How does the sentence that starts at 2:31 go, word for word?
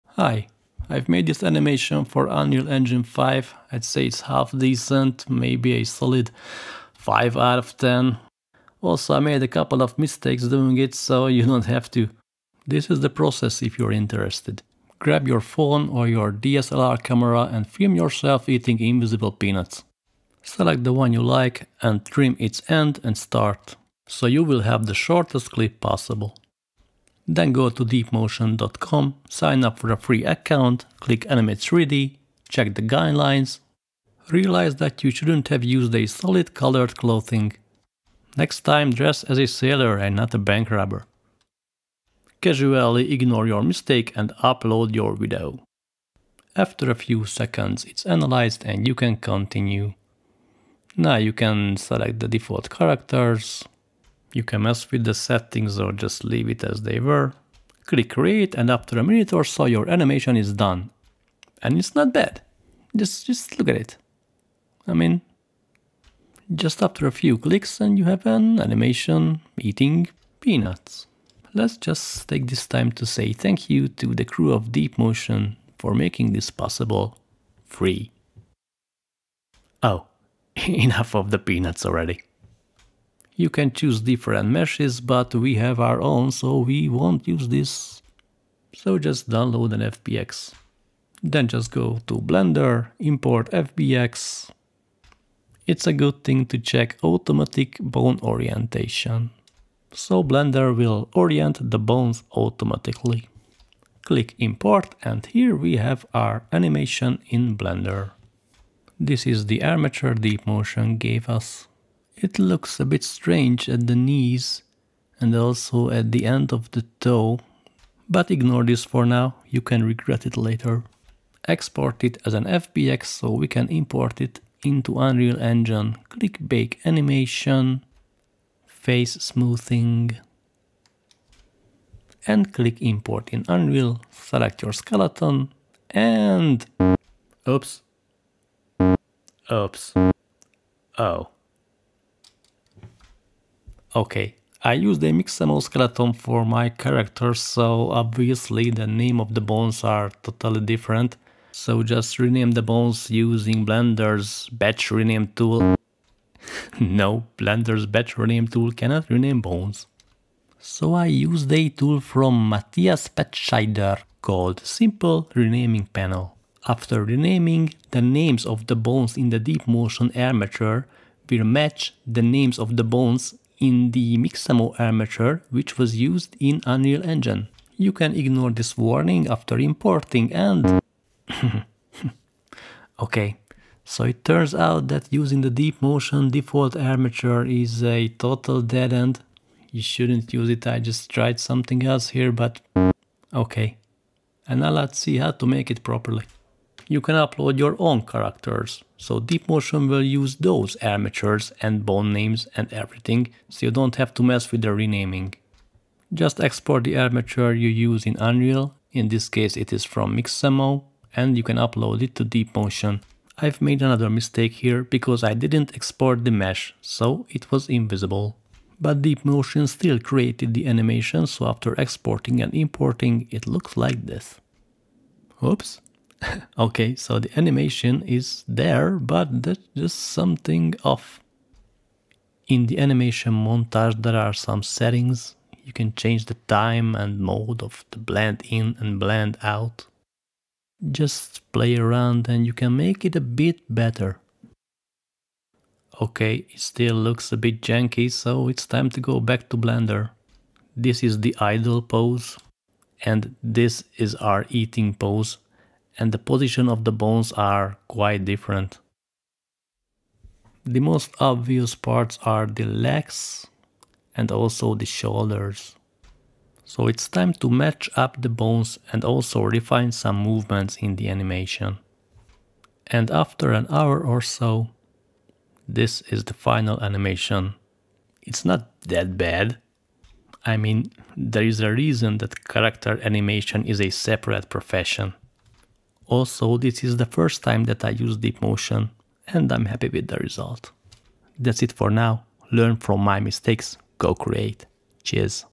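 So just rename the bones using Blender's batch rename tool.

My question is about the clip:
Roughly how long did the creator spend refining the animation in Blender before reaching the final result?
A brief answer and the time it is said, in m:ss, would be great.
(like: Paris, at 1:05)
An hour, at 4:33.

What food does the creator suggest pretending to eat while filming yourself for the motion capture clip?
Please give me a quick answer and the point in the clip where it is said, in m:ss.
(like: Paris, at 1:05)
Invisible peanuts, at 0:18.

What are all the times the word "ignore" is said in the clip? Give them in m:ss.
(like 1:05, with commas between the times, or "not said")
0:43, 1:58, 2:58.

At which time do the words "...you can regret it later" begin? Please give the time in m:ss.
1:59.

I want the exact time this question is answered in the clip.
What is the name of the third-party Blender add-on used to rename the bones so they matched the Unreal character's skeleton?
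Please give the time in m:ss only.
2:44.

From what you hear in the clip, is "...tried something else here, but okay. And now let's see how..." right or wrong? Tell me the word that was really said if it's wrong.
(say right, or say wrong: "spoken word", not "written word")
right.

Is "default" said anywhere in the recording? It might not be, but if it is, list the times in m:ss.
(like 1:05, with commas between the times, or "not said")
0:52, 3:06.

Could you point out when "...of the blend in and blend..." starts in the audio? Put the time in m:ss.
3:57.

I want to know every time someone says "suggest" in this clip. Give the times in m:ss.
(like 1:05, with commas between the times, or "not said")
not said.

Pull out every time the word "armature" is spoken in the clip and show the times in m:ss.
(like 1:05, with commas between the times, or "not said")
1:49, 2:50, 2:54, 3:06, 3:20, 3:26.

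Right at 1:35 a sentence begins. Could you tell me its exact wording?
It's a good thing to check automatic bone orientation.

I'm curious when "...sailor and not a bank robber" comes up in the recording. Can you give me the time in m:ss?
0:39.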